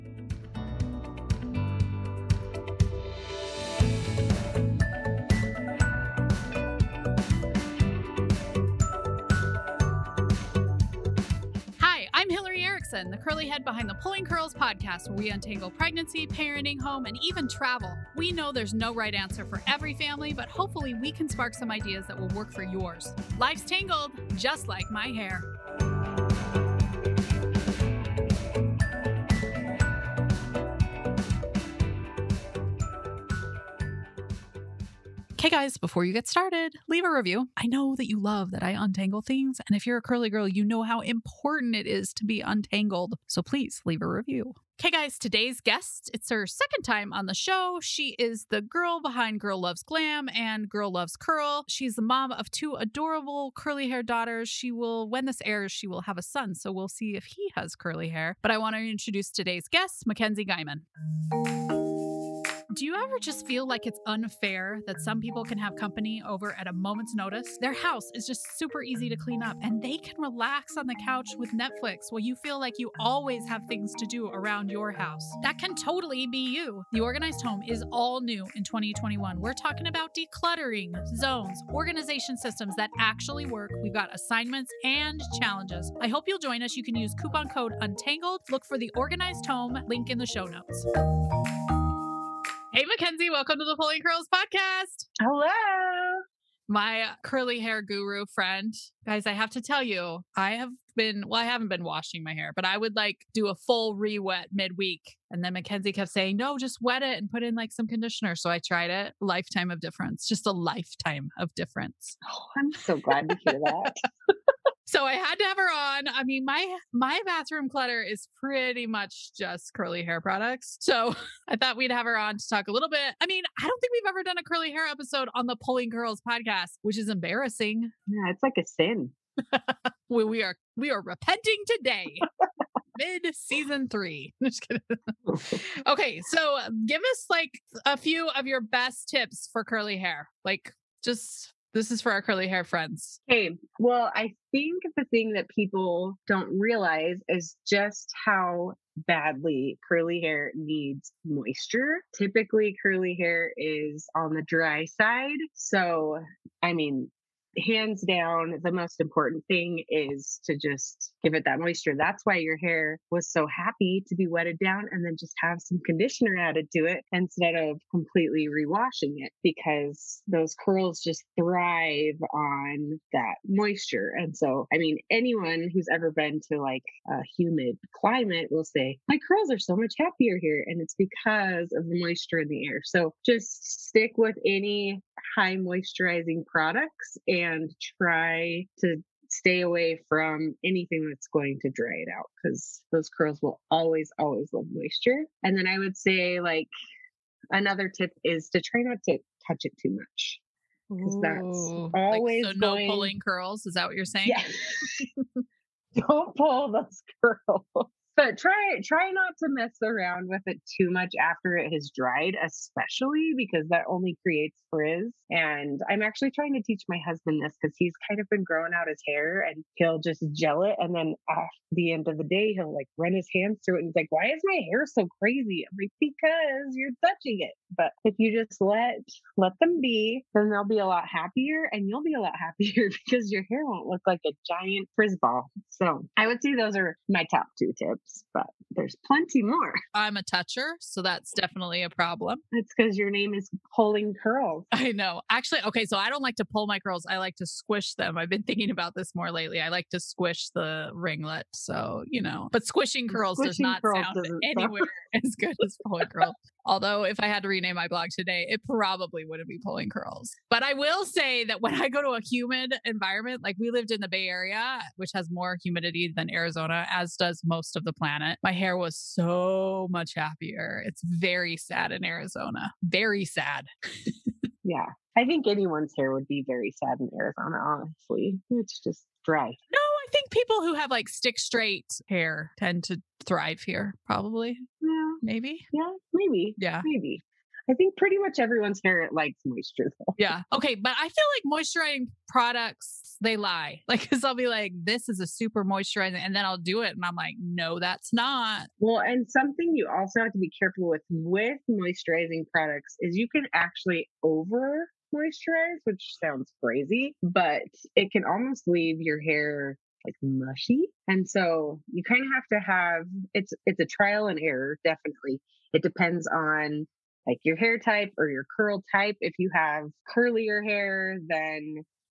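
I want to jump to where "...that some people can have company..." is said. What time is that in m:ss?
1:04.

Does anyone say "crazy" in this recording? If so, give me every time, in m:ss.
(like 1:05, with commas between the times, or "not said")
3:45, 5:06.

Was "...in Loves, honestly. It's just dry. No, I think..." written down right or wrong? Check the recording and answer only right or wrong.
wrong.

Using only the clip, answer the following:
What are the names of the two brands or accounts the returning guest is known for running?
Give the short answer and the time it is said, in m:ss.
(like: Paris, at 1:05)
Girl Loves Glam and Girl Loves Curl, at 0:49.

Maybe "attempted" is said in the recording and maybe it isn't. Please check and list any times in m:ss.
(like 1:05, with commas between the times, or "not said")
not said.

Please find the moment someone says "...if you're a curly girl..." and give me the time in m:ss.
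0:39.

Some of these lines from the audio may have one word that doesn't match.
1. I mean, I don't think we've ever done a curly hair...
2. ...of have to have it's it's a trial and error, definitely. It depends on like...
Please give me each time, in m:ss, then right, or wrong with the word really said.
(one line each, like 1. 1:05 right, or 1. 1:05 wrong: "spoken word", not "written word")
1. 2:03 right
2. 5:12 right.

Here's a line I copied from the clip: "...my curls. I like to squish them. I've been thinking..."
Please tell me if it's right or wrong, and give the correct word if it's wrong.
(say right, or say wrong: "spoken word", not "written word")
right.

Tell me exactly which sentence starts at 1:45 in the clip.
And then McKenzie kept saying, no, just wet it and put in like some conditioner.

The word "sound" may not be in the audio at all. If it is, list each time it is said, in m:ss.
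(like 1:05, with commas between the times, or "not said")
4:14, 5:06.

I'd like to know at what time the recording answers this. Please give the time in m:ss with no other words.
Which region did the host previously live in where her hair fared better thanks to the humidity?
4:24.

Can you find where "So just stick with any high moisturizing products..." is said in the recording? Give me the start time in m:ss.
3:02.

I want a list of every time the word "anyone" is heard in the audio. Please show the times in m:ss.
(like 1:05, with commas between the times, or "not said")
2:55, 4:35.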